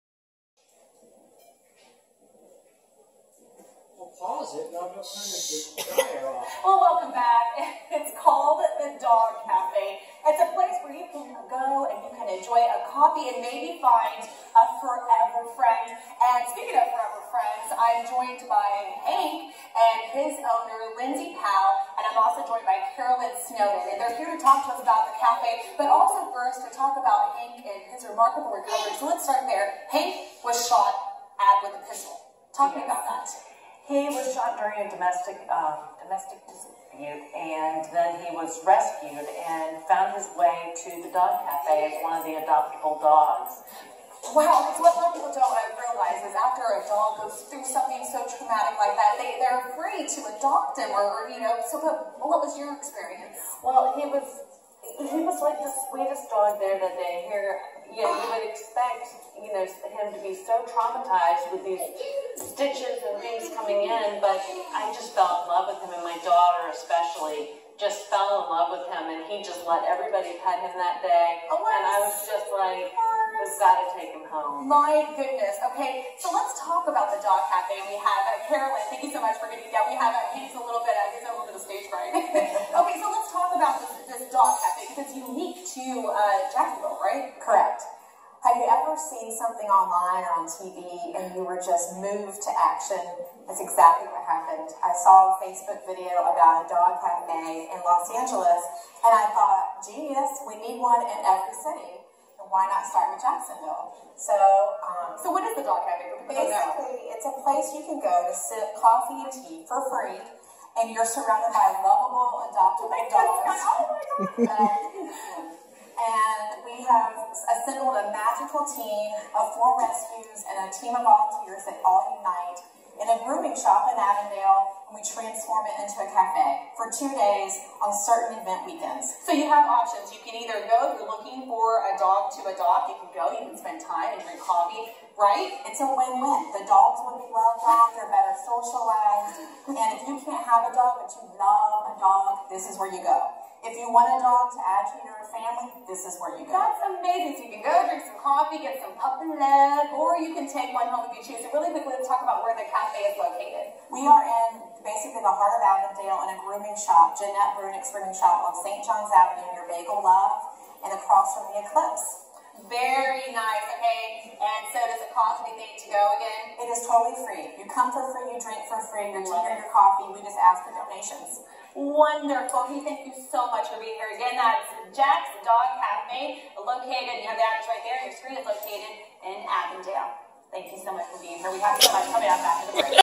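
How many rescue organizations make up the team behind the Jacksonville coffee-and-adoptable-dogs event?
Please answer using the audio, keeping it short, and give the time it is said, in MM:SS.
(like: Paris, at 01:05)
4, at 01:59.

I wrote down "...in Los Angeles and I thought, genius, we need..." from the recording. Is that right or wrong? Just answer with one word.
right.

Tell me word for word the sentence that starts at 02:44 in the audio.
And so does it cost anything to go again?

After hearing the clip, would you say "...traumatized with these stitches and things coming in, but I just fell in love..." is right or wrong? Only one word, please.
right.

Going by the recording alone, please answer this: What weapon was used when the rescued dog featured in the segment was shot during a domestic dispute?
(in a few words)
pistol.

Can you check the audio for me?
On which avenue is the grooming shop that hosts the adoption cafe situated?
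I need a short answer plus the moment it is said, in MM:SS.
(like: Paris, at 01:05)
St. John's Avenue, at 02:38.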